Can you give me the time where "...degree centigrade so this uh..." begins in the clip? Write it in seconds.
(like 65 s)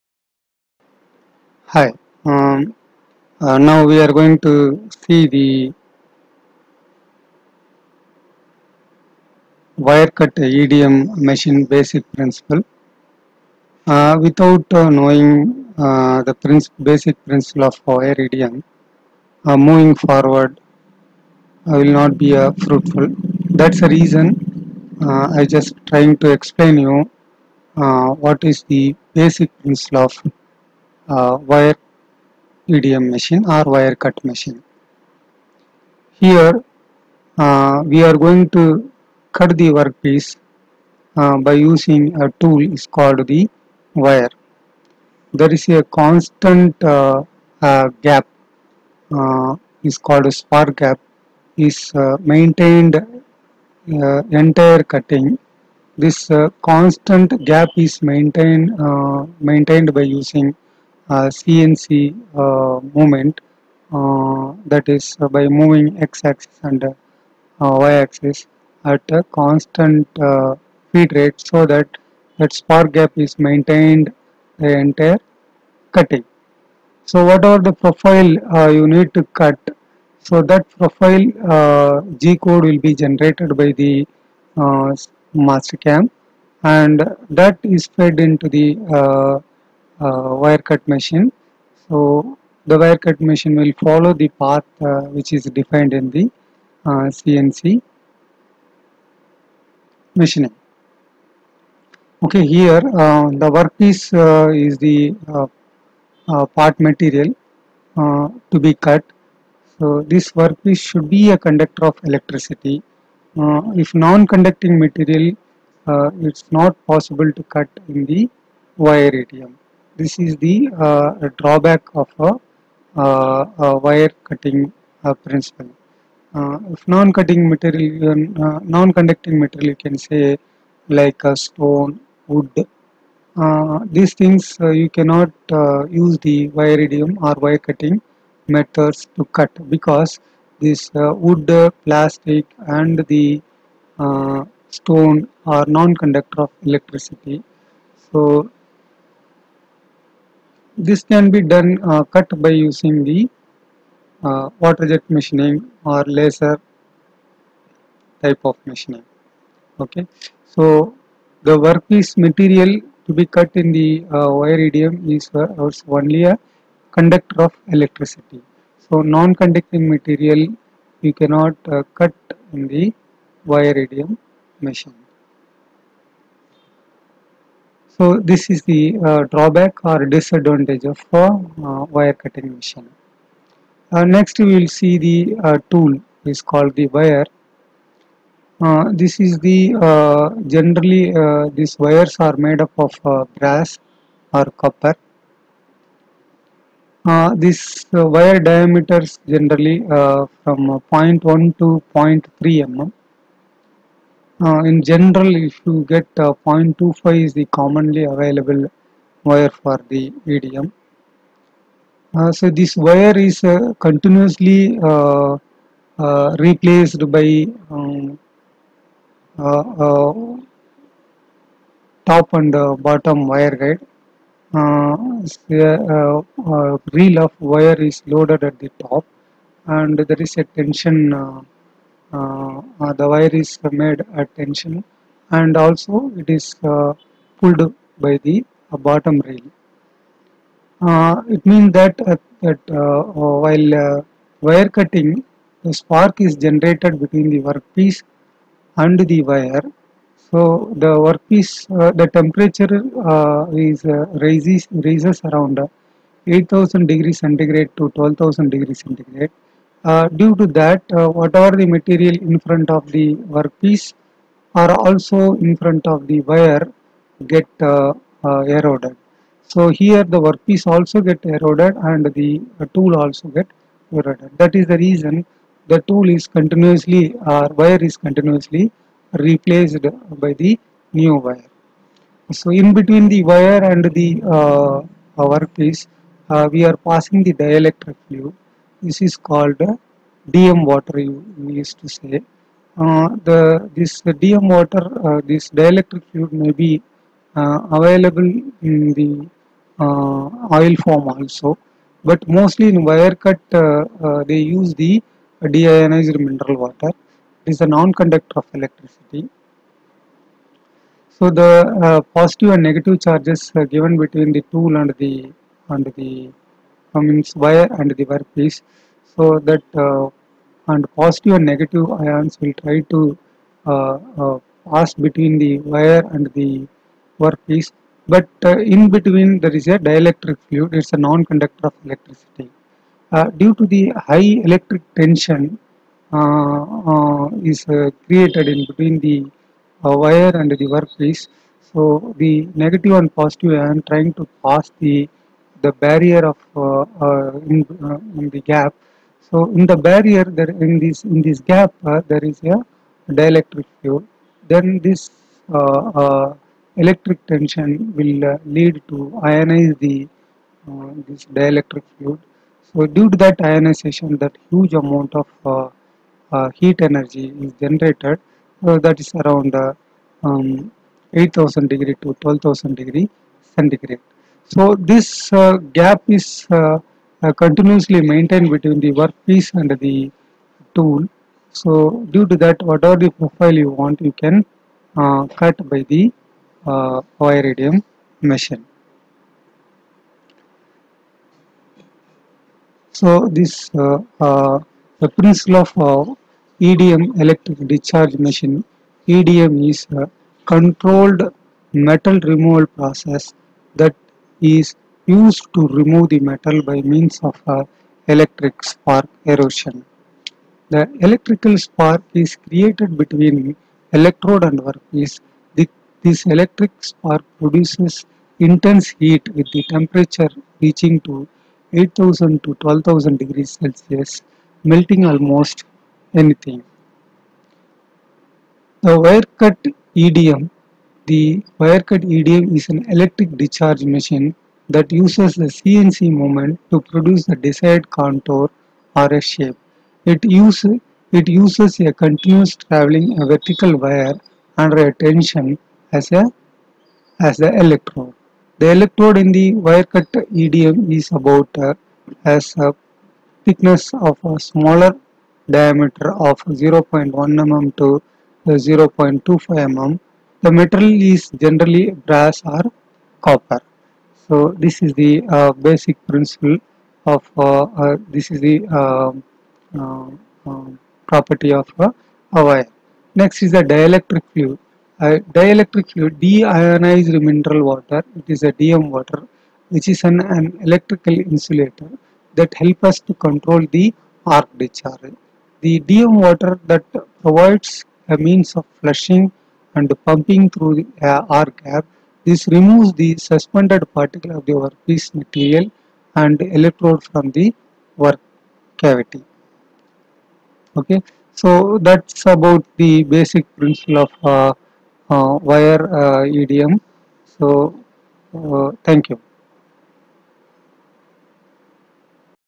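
372 s.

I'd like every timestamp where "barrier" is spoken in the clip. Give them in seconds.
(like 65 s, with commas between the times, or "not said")
345 s, 349 s.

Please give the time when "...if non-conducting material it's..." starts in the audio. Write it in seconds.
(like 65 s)
113 s.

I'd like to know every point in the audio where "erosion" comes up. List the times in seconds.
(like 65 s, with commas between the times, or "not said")
409 s.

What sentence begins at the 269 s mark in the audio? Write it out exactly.
So here the workpiece also get eroded and the tool also get eroded.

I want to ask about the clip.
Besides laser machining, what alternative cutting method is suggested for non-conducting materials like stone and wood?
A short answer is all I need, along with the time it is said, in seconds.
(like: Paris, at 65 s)
Water jet machining, at 154 s.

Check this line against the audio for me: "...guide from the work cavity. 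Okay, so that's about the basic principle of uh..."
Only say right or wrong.
wrong.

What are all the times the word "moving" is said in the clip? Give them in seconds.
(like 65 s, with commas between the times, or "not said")
19 s, 65 s.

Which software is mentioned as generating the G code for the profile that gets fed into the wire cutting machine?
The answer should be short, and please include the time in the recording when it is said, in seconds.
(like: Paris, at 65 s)
Mastercam, at 85 s.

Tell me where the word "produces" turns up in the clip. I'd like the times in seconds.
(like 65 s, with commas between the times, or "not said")
417 s, 436 s.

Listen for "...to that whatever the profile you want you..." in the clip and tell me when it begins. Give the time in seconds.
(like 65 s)
382 s.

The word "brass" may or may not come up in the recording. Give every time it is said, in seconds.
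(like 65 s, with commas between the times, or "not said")
193 s, 461 s.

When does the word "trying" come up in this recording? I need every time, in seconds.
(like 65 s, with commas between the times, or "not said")
25 s, 343 s.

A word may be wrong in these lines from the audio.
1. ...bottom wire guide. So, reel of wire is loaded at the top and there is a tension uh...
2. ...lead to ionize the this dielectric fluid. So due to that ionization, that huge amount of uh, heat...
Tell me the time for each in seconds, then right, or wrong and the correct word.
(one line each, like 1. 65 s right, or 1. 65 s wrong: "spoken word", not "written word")
1. 222 s right
2. 358 s right.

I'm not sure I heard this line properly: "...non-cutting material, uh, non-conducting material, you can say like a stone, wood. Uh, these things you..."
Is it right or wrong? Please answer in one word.
right.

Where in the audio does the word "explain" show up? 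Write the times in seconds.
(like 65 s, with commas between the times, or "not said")
26 s.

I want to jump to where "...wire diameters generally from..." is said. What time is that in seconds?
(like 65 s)
197 s.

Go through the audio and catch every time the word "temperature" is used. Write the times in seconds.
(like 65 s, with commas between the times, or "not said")
252 s, 419 s.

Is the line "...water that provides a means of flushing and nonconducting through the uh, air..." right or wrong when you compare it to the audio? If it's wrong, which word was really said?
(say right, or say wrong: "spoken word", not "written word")
wrong: "pumping", not "nonconducting".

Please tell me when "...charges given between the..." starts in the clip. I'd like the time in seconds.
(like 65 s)
313 s.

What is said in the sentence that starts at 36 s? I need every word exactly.
Here uh, we are going to cut the workpiece uh, by using a tool is called the wire.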